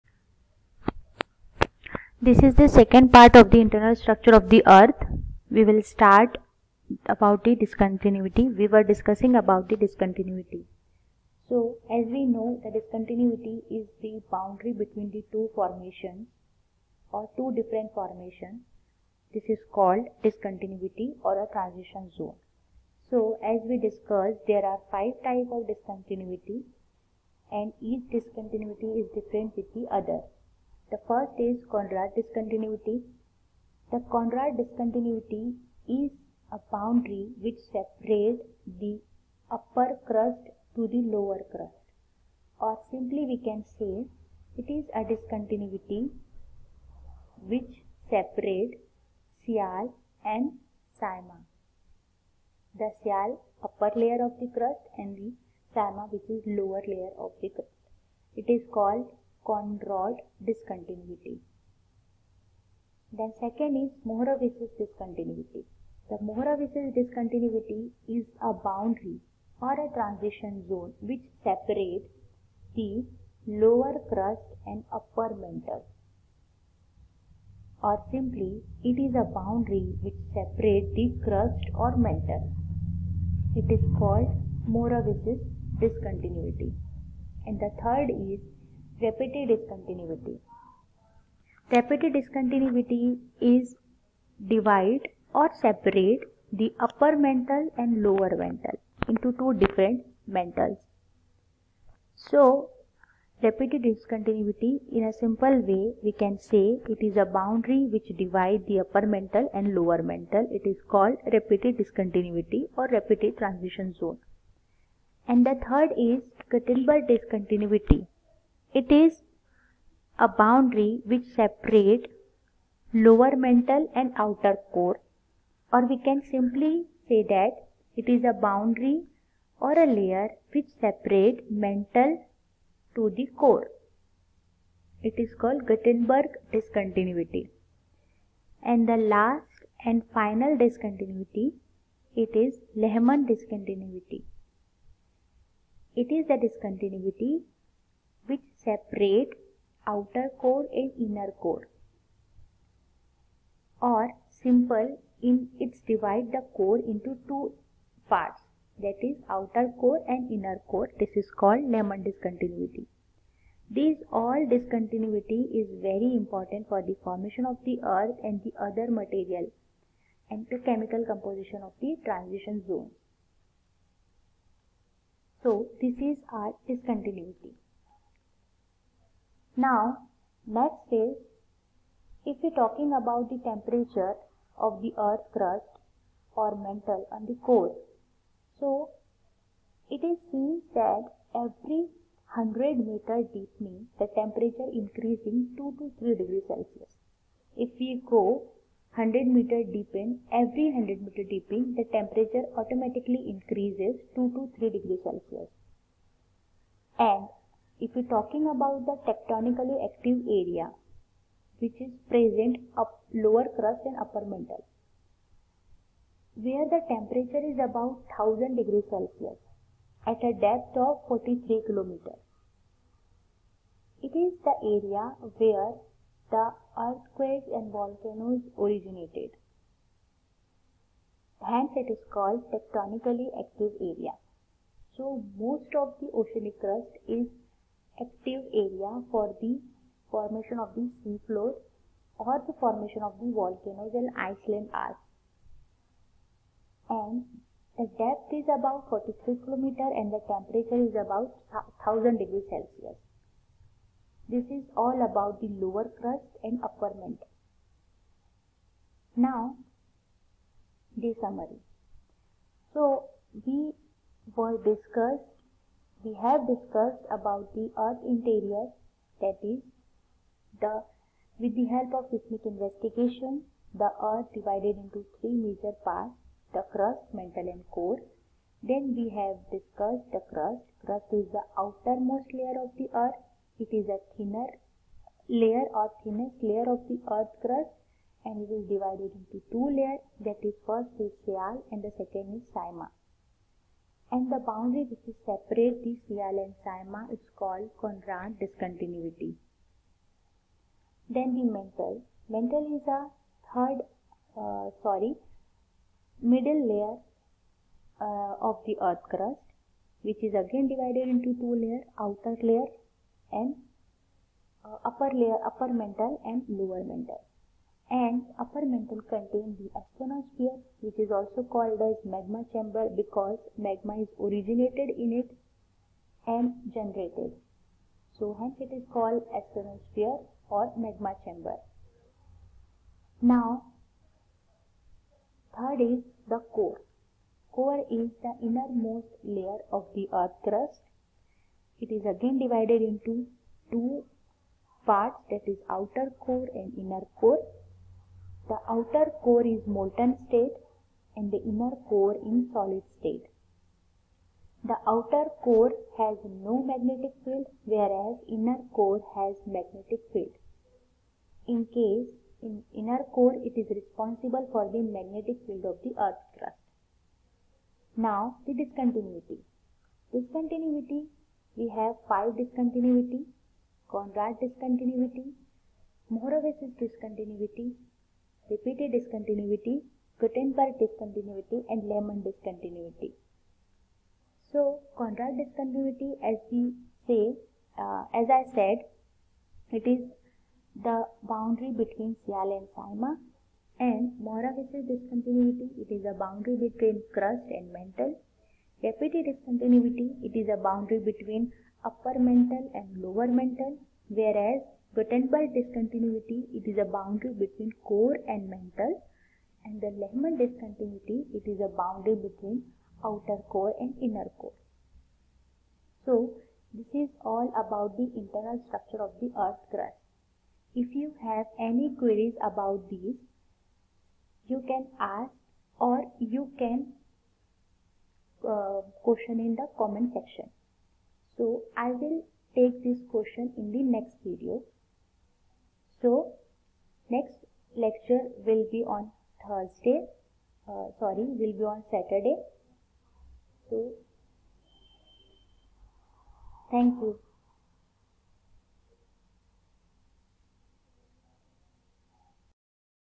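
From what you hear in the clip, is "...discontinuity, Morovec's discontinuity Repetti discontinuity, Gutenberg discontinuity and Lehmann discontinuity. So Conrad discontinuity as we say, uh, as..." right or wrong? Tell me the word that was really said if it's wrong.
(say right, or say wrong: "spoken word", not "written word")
right.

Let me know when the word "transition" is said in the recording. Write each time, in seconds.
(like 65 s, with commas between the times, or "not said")
21 s, 69 s, 113 s, 172 s.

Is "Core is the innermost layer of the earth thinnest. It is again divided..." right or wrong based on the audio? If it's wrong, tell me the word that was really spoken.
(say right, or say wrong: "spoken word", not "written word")
wrong: "crust", not "thinnest".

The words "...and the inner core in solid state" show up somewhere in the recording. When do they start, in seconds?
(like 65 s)
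351 s.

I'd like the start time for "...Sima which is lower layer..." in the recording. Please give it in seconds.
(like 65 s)
55 s.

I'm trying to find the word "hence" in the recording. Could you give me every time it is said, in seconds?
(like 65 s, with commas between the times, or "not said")
231 s, 328 s.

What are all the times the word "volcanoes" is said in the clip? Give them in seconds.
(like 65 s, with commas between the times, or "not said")
227 s, 243 s.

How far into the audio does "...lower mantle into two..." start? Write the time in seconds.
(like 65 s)
98 s.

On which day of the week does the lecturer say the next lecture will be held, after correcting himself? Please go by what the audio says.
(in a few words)
Saturday.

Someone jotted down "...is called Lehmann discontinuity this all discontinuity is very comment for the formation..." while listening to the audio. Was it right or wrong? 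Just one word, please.
wrong.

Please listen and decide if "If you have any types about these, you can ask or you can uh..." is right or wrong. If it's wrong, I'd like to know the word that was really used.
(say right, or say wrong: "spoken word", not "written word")
wrong: "queries", not "types".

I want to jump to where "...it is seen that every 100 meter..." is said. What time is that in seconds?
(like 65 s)
189 s.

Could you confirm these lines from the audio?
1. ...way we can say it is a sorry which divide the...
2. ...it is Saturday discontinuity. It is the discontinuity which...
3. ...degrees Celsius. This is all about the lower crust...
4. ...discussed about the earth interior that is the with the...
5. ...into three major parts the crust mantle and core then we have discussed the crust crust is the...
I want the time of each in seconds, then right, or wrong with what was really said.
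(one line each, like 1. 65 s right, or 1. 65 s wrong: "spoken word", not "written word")
1. 105 s wrong: "boundary", not "sorry"
2. 142 s wrong: "Lehmann", not "Saturday"
3. 252 s right
4. 266 s right
5. 274 s right.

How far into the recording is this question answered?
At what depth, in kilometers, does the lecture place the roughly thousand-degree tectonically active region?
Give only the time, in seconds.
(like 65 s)
248 s.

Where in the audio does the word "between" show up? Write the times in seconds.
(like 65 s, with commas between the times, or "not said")
14 s, 391 s, 396 s, 400 s, 407 s, 412 s.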